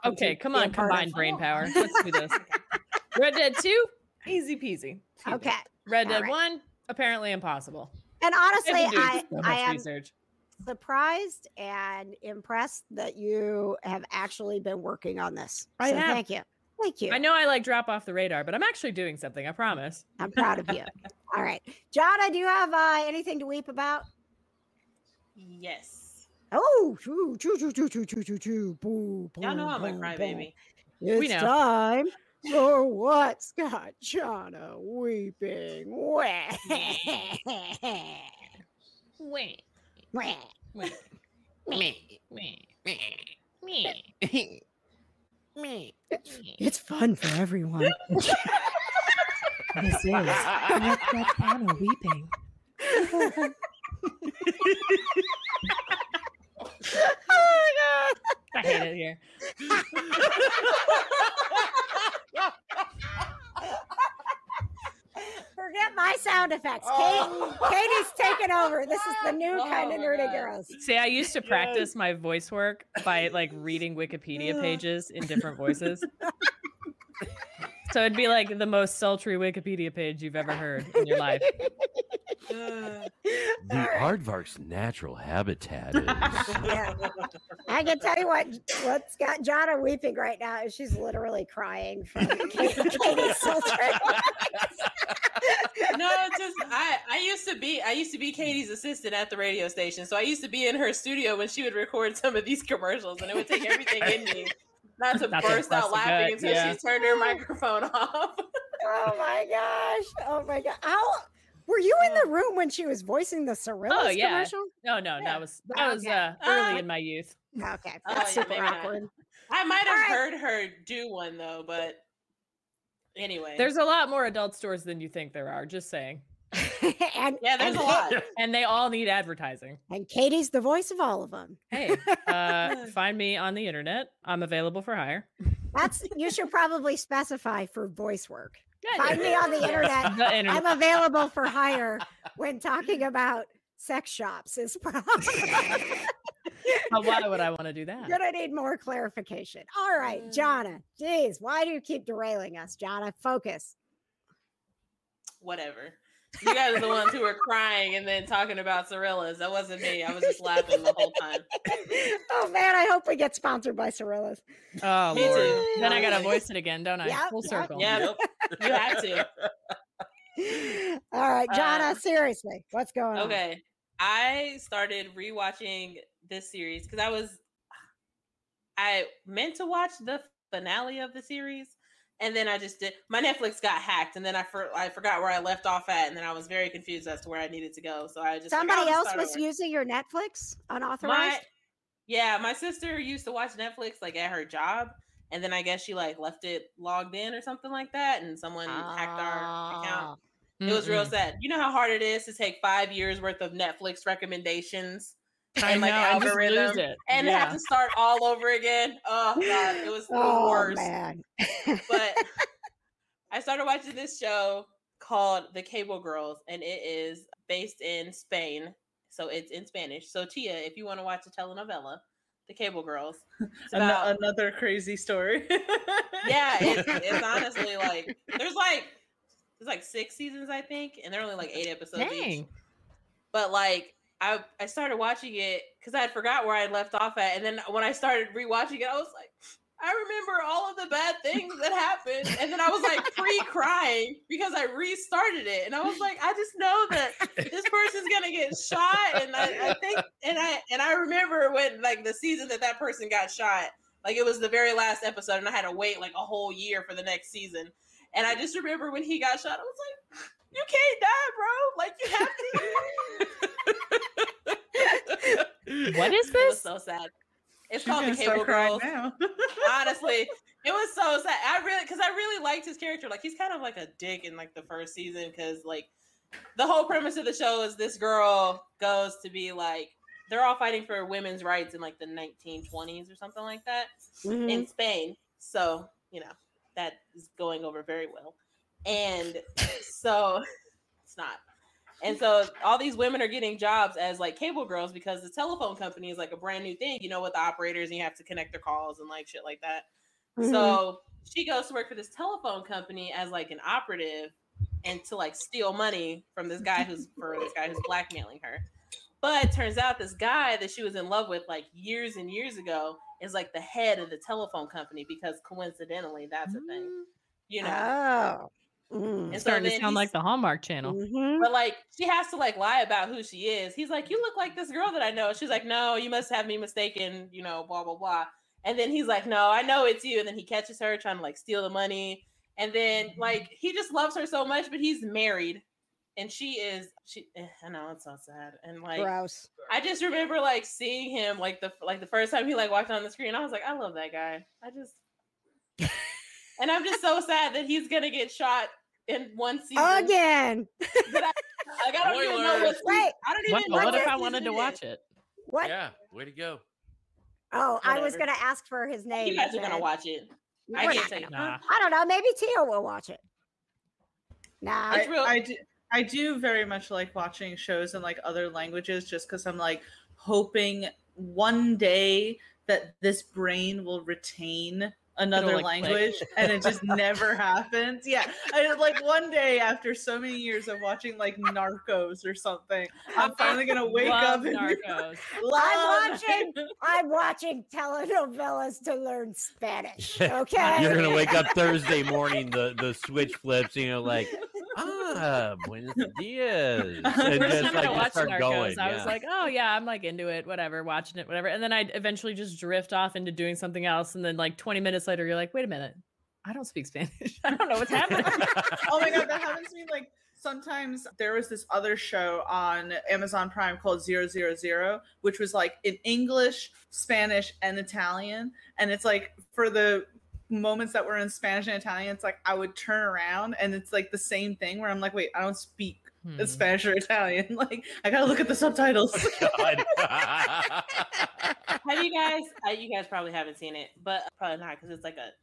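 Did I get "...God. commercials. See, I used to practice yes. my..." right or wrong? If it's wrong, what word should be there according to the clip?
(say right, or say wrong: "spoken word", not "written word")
wrong: "girls", not "commercials".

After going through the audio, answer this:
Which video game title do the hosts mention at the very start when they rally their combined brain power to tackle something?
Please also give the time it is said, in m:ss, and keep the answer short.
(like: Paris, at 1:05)
Red Dead 2, at 0:03.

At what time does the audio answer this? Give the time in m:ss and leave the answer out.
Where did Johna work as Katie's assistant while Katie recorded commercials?
1:39.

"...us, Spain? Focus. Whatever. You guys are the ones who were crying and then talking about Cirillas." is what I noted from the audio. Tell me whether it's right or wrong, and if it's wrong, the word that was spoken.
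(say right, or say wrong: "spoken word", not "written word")
wrong: "Johna", not "Spain".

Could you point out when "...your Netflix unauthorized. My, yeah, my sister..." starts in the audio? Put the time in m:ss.
3:09.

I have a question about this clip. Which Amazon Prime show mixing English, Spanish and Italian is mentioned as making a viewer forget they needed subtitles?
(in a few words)
Zero Zero Zero.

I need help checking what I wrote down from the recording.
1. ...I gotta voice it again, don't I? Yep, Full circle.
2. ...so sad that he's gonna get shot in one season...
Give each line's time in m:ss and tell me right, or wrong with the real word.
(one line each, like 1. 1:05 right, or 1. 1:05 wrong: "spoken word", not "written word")
1. 2:45 right
2. 5:47 right.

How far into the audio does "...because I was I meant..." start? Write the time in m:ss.
2:56.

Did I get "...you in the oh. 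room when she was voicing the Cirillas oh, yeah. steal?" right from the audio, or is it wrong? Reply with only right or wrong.
wrong.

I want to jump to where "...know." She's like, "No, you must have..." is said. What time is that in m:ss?
5:25.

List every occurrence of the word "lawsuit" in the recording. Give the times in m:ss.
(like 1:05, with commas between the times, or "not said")
not said.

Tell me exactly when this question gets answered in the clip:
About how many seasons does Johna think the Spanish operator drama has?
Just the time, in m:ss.
3:49.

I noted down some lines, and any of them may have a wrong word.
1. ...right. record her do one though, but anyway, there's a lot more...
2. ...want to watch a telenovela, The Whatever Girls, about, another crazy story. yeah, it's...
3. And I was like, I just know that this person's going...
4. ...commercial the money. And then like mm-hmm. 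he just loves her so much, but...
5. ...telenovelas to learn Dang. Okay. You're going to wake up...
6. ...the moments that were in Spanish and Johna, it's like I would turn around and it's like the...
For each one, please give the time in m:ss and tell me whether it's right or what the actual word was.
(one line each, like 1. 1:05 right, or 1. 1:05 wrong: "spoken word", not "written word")
1. 1:59 wrong: "heard", not "record"
2. 3:40 wrong: "Cable", not "Whatever"
3. 4:05 right
4. 5:31 wrong: "steal", not "commercial"
5. 6:27 wrong: "Spanish", not "Dang"
6. 6:59 wrong: "Italian", not "Johna".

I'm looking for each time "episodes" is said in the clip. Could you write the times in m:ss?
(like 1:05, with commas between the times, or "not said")
3:51, 4:15.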